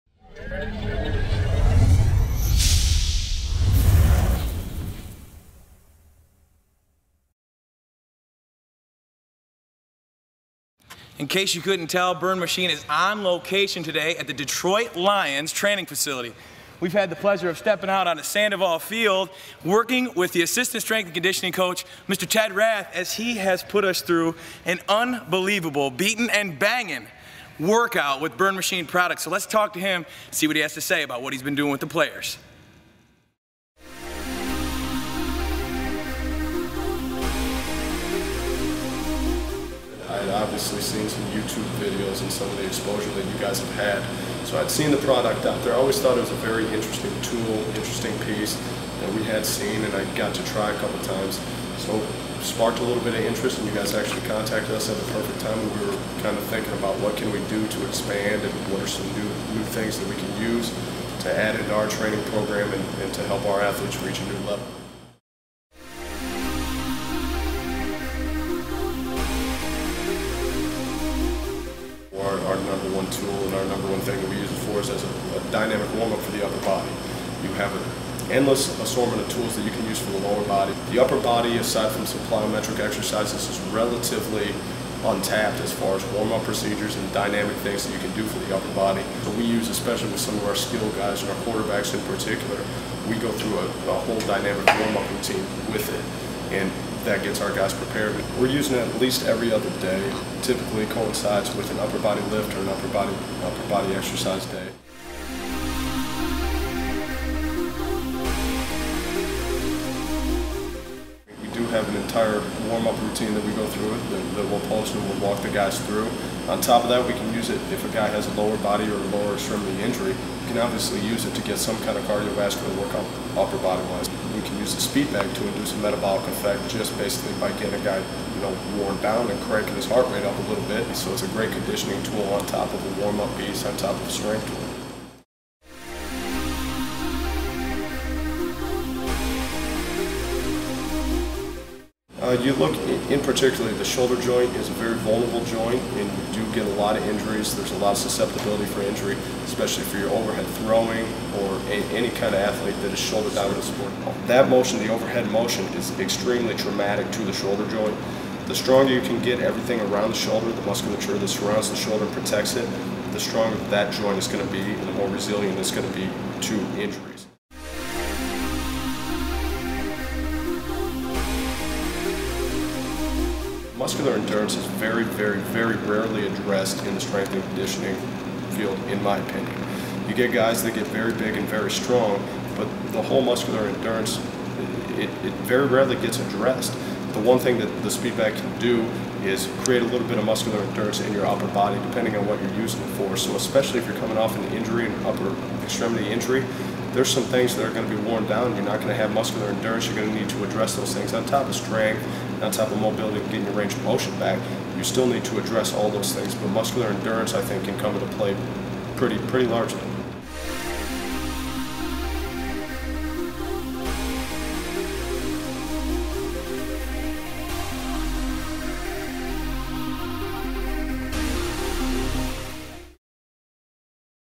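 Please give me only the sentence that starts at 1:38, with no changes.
We're using it at least every other day.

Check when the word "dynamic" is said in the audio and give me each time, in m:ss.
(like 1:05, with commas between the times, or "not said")
1:15, 1:27, 1:34.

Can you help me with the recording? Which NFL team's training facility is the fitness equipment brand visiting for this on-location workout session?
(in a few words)
Detroit Lions.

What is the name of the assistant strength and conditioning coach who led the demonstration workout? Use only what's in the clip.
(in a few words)
Ted Rath.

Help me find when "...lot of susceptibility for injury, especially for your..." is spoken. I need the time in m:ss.
2:27.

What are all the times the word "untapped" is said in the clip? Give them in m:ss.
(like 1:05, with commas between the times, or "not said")
1:25.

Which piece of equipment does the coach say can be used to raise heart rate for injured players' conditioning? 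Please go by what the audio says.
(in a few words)
speed bag.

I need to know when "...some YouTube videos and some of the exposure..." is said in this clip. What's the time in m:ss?
0:41.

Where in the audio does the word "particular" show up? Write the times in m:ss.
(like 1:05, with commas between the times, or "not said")
1:32, 2:23.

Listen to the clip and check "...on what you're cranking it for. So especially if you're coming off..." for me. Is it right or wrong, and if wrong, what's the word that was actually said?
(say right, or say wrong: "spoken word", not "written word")
wrong: "using", not "cranking".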